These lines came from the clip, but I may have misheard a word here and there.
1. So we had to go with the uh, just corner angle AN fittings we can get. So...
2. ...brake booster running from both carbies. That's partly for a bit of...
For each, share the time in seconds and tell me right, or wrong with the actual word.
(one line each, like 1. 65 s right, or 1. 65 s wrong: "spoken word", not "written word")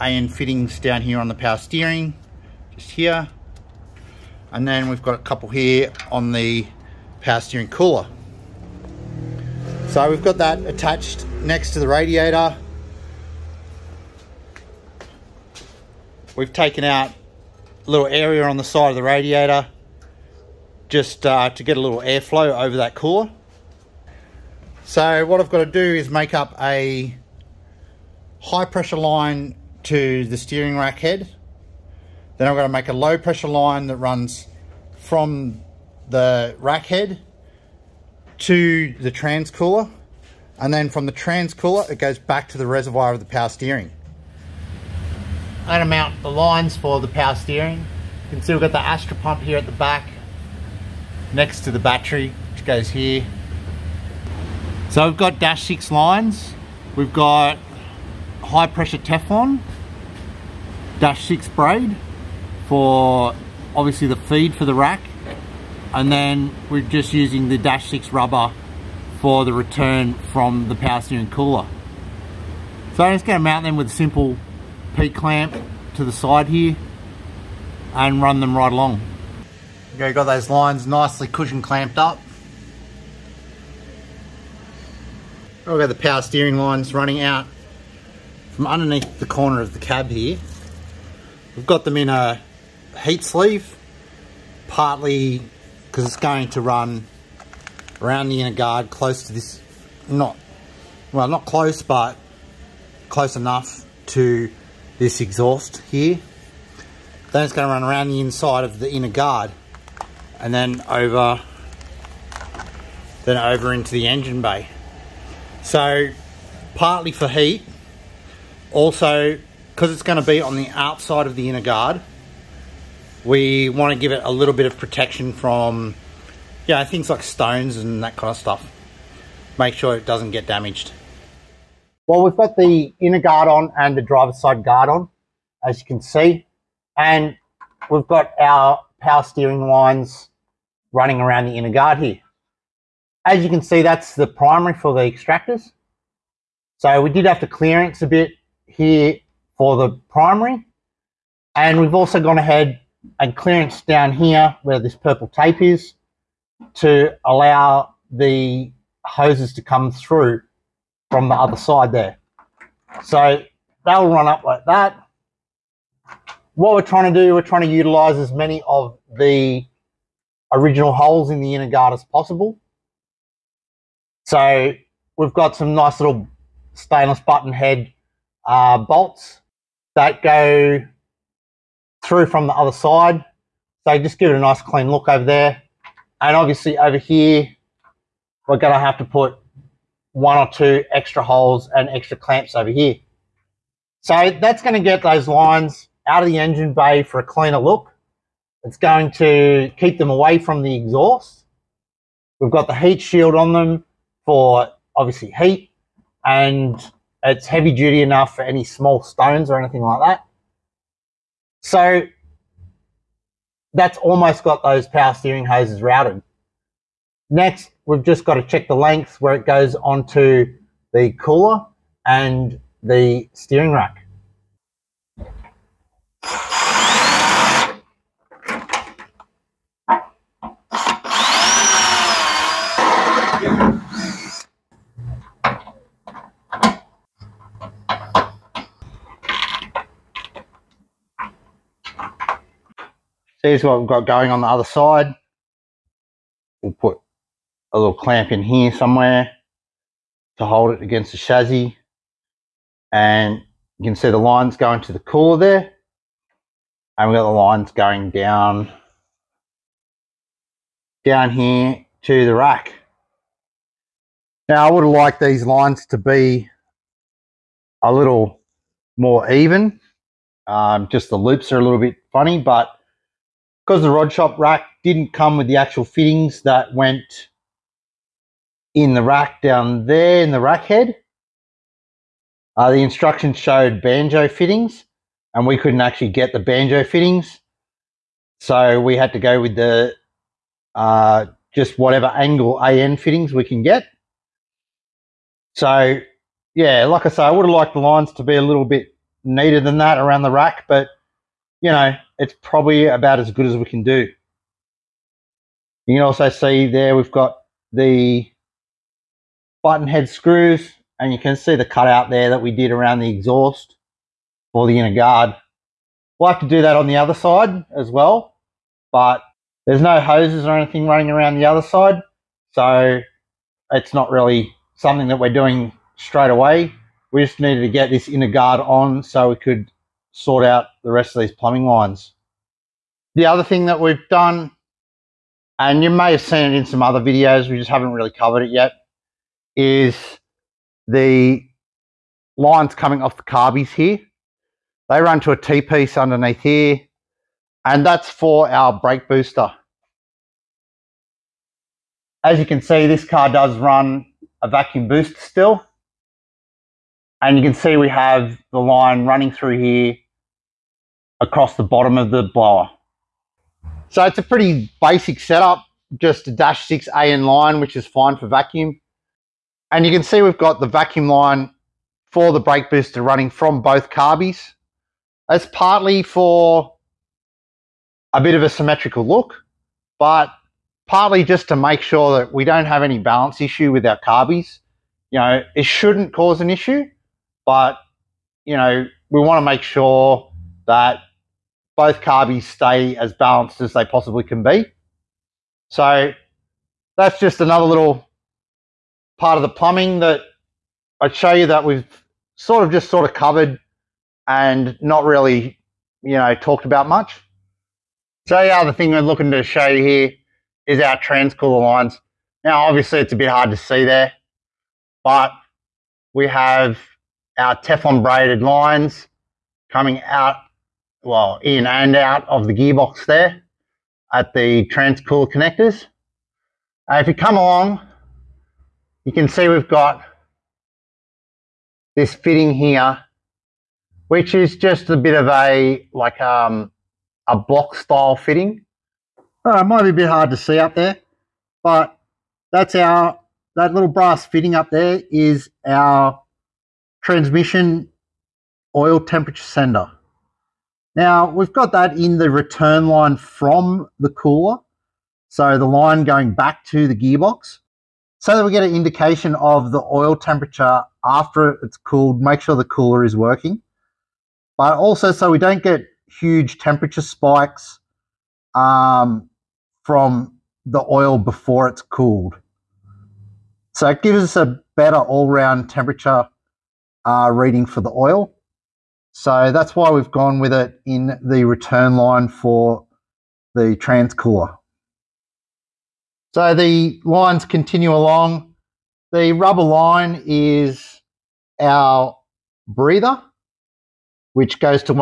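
1. 288 s wrong: "whatever", not "corner"
2. 372 s right.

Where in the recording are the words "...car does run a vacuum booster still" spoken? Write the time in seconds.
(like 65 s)
353 s.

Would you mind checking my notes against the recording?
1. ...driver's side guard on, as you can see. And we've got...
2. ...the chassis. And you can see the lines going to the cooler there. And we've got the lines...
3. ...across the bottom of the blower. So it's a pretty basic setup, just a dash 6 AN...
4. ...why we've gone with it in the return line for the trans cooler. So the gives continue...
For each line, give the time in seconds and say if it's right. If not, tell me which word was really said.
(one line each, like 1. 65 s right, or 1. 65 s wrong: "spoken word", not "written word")
1. 134 s right
2. 251 s right
3. 361 s right
4. 479 s wrong: "lines", not "gives".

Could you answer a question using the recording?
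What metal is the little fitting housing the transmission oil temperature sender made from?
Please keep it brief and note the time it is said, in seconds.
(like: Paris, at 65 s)
Brass, at 443 s.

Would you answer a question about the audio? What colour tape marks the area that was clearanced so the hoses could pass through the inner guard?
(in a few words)
Purple.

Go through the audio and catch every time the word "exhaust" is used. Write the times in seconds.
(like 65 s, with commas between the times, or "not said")
105 s, 200 s, 313 s.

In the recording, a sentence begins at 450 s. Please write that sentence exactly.
Now we've got that in the return line from the cooler.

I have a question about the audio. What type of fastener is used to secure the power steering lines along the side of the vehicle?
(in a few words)
P-clamp.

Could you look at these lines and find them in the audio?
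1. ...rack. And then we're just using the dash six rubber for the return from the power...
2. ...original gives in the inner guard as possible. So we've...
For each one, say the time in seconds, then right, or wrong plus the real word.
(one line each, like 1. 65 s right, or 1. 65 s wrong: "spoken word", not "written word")
1. 64 s right
2. 170 s wrong: "holes", not "gives".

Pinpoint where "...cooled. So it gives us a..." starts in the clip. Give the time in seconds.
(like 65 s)
471 s.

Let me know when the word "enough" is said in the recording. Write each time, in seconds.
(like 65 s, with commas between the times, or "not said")
103 s, 208 s.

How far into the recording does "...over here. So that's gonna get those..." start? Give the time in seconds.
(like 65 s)
192 s.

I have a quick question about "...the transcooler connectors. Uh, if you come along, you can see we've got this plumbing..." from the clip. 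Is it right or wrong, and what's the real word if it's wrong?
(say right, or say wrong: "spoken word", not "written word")
wrong: "fitting", not "plumbing".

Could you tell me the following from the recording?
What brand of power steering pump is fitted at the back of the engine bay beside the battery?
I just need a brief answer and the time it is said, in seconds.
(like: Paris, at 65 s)
Astra, at 48 s.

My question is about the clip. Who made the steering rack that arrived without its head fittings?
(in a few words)
Rod shop.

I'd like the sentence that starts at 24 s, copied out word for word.
So what I've got to do is make up a high pressure line to the steering rack head.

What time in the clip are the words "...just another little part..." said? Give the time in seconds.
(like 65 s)
397 s.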